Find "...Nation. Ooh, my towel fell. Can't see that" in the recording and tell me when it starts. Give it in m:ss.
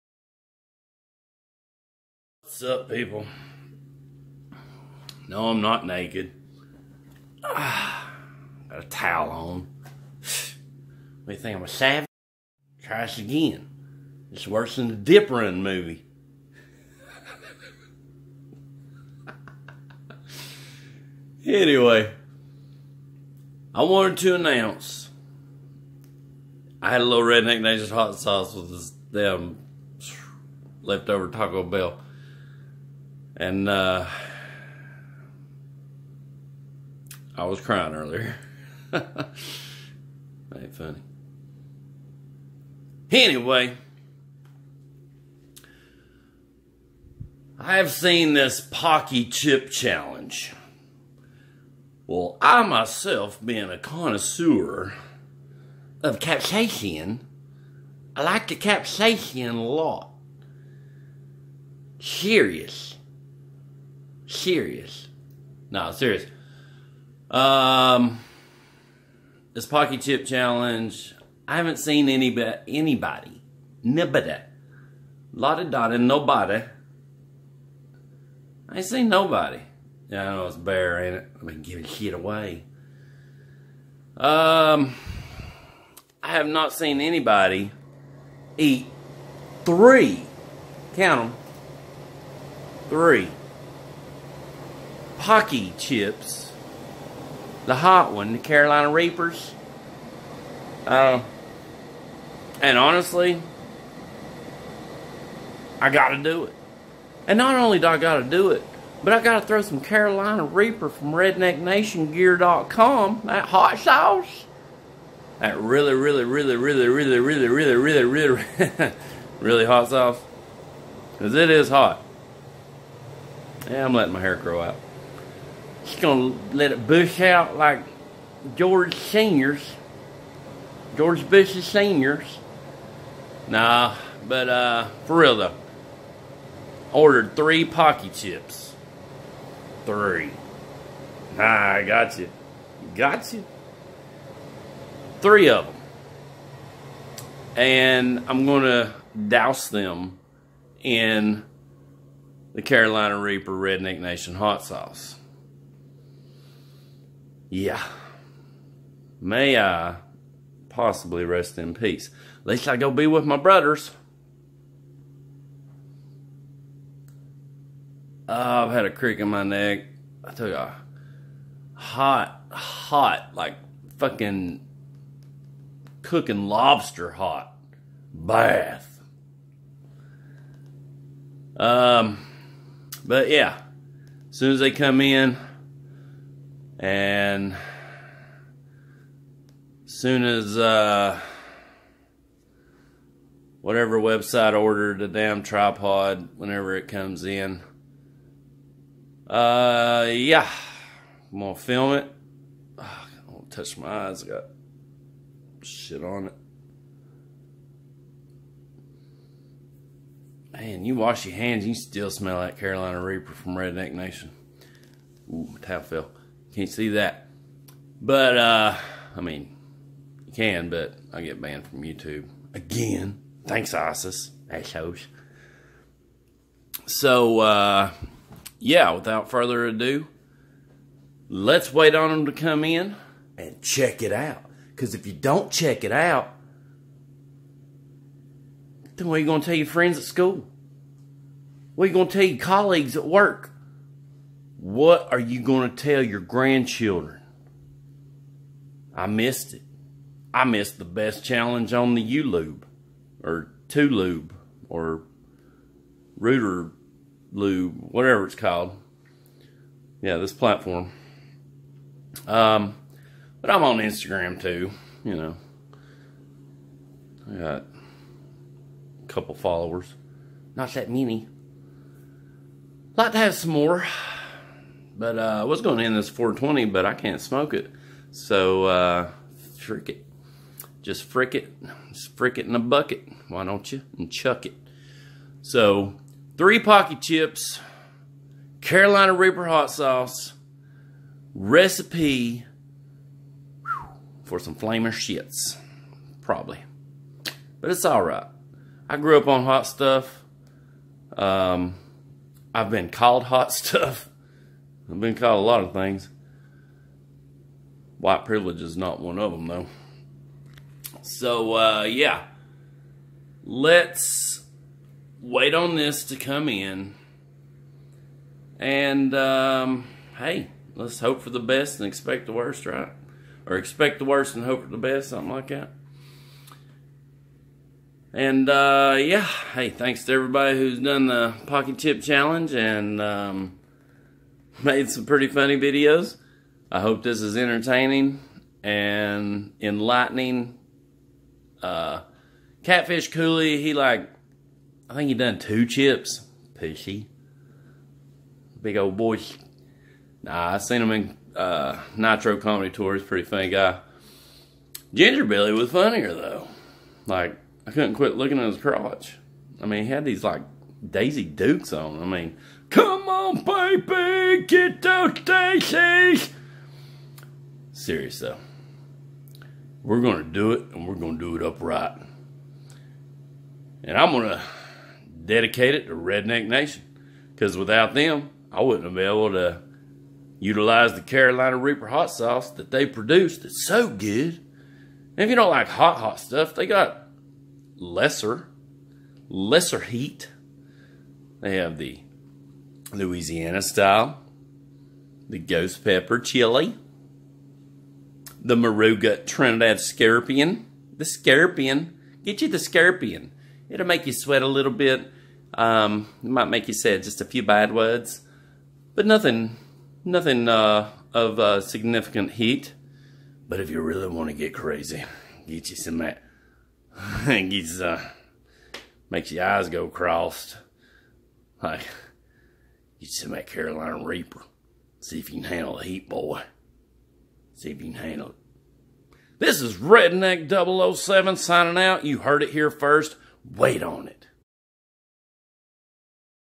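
3:33.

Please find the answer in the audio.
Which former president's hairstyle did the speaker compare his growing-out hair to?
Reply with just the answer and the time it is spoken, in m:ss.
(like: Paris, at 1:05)
George Bush Senior, at 2:10.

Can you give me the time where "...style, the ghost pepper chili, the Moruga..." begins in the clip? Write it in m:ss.
6:33.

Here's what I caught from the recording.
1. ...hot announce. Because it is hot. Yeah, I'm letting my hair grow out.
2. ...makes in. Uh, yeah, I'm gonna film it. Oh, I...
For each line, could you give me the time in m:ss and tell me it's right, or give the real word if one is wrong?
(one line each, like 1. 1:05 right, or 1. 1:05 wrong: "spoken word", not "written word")
1. 1:59 wrong: "sauce", not "announce"
2. 3:16 wrong: "comes", not "makes".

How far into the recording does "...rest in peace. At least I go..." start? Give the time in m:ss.
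2:41.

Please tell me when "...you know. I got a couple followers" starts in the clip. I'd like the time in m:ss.
4:25.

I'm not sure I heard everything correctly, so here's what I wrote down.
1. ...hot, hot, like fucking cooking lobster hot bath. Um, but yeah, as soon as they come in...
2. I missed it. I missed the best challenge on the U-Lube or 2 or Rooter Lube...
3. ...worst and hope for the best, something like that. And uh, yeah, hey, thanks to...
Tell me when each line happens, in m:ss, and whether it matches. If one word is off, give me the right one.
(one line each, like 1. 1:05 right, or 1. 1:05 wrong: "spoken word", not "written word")
1. 2:51 right
2. 4:08 right
3. 5:24 right.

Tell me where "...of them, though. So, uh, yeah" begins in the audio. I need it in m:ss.
5:09.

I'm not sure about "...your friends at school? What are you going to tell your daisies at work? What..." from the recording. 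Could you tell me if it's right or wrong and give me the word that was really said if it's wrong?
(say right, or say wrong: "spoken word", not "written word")
wrong: "colleagues", not "daisies".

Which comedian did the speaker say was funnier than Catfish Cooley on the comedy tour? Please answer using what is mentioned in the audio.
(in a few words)
Ginger Billy.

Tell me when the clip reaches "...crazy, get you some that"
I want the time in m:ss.
6:54.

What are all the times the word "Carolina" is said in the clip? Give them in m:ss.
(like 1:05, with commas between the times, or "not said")
1:38, 1:49, 2:32, 3:32, 4:48, 6:21, 7:03.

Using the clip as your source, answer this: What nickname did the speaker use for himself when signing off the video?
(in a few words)
Redneck 007.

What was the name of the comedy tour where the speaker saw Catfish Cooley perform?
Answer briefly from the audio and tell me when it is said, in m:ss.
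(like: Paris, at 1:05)
Nitro Comedy Tour, at 5:51.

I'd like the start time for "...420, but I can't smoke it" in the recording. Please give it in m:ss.
4:36.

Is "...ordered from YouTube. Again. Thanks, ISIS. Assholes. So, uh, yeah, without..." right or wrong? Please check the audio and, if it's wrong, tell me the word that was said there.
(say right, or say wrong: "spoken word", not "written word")
wrong: "banned", not "ordered".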